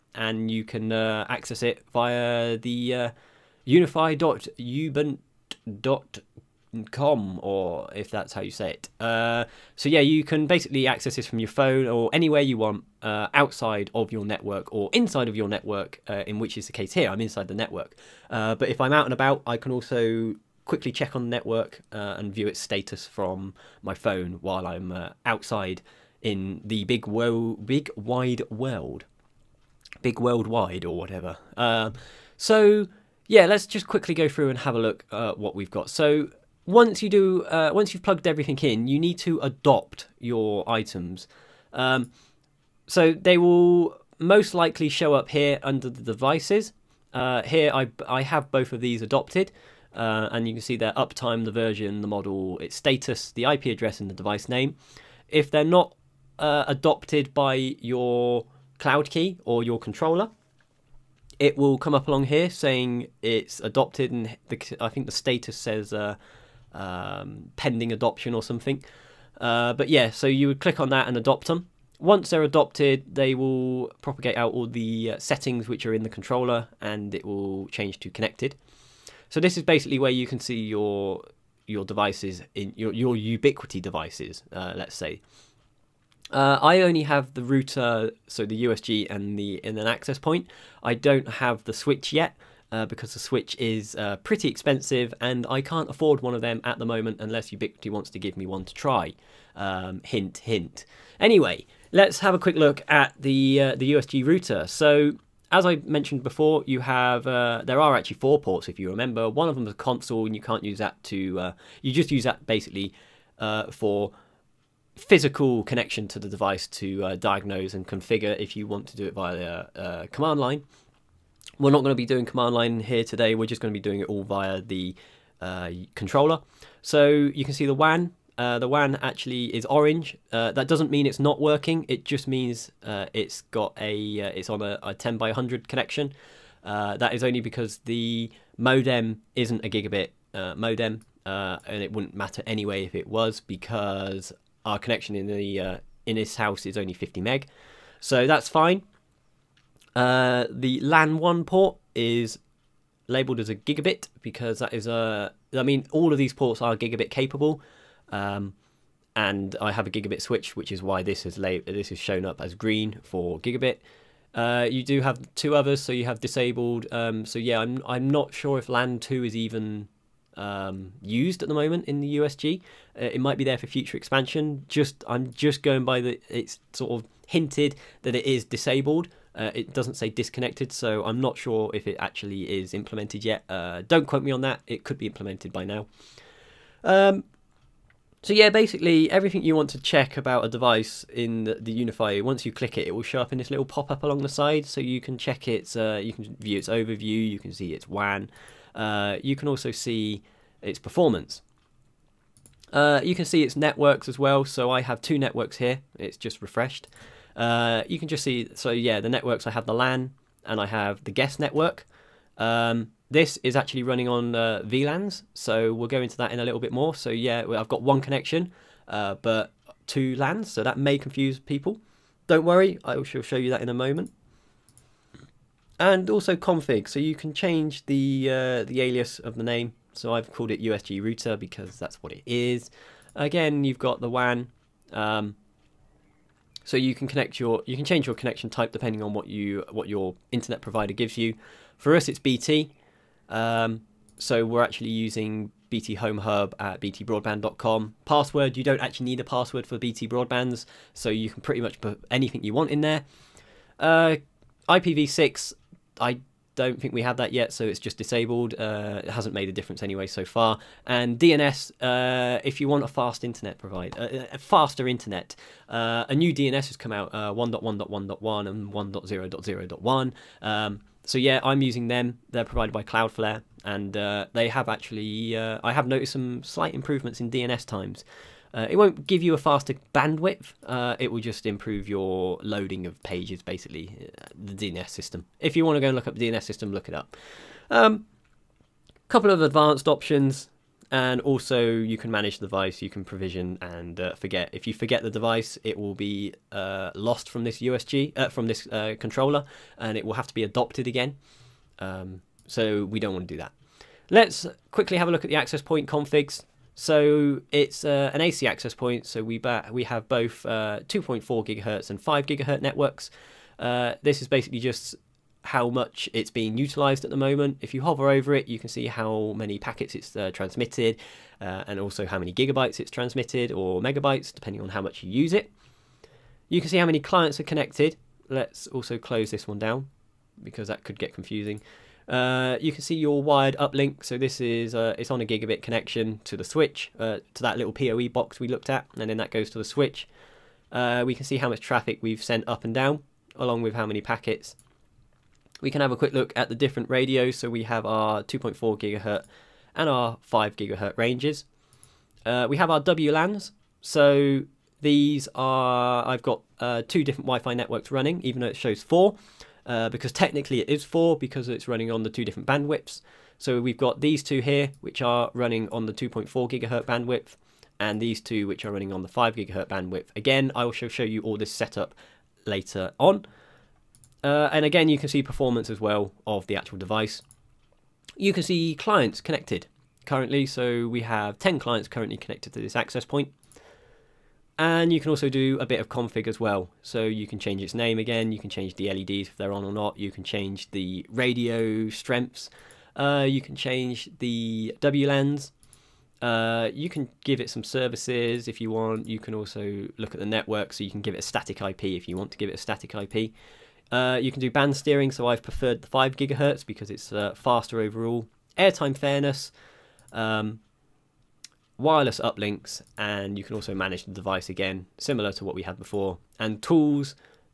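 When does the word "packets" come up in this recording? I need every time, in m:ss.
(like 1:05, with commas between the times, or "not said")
5:19, 5:44.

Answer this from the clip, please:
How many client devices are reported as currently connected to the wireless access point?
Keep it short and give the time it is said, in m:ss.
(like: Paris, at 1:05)
10, at 6:21.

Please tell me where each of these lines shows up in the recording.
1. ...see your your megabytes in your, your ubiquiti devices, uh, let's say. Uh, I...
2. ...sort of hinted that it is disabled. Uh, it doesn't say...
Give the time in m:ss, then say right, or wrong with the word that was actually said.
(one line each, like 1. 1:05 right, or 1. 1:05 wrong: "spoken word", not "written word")
1. 1:20 wrong: "devices", not "megabytes"
2. 2:56 right.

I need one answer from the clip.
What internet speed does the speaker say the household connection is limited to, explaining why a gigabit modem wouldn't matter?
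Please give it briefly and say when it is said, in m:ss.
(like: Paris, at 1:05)
50 meg, at 2:26.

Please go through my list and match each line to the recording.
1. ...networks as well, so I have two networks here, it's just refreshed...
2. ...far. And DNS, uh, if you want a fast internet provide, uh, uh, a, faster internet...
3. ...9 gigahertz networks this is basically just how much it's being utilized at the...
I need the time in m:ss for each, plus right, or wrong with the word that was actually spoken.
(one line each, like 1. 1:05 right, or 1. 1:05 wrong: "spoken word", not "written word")
1. 3:23 right
2. 4:20 right
3. 5:11 wrong: "5", not "9".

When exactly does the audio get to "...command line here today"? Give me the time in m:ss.
2:02.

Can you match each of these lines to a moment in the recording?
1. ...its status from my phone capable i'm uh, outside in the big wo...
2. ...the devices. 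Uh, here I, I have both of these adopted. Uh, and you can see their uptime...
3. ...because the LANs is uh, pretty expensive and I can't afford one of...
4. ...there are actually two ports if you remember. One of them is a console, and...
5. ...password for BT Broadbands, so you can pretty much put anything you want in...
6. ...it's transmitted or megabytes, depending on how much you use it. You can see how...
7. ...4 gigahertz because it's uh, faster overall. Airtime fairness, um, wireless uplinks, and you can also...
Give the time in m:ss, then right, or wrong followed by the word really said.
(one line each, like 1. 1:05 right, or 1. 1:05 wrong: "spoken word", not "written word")
1. 0:22 wrong: "while", not "capable"
2. 0:45 right
3. 1:32 wrong: "Switch", not "LANs"
4. 1:47 wrong: "four", not "two"
5. 4:09 right
6. 5:22 right
7. 6:45 wrong: "5", not "4".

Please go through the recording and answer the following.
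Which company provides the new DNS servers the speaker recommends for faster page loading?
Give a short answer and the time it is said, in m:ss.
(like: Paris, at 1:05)
Cloudflare, at 4:32.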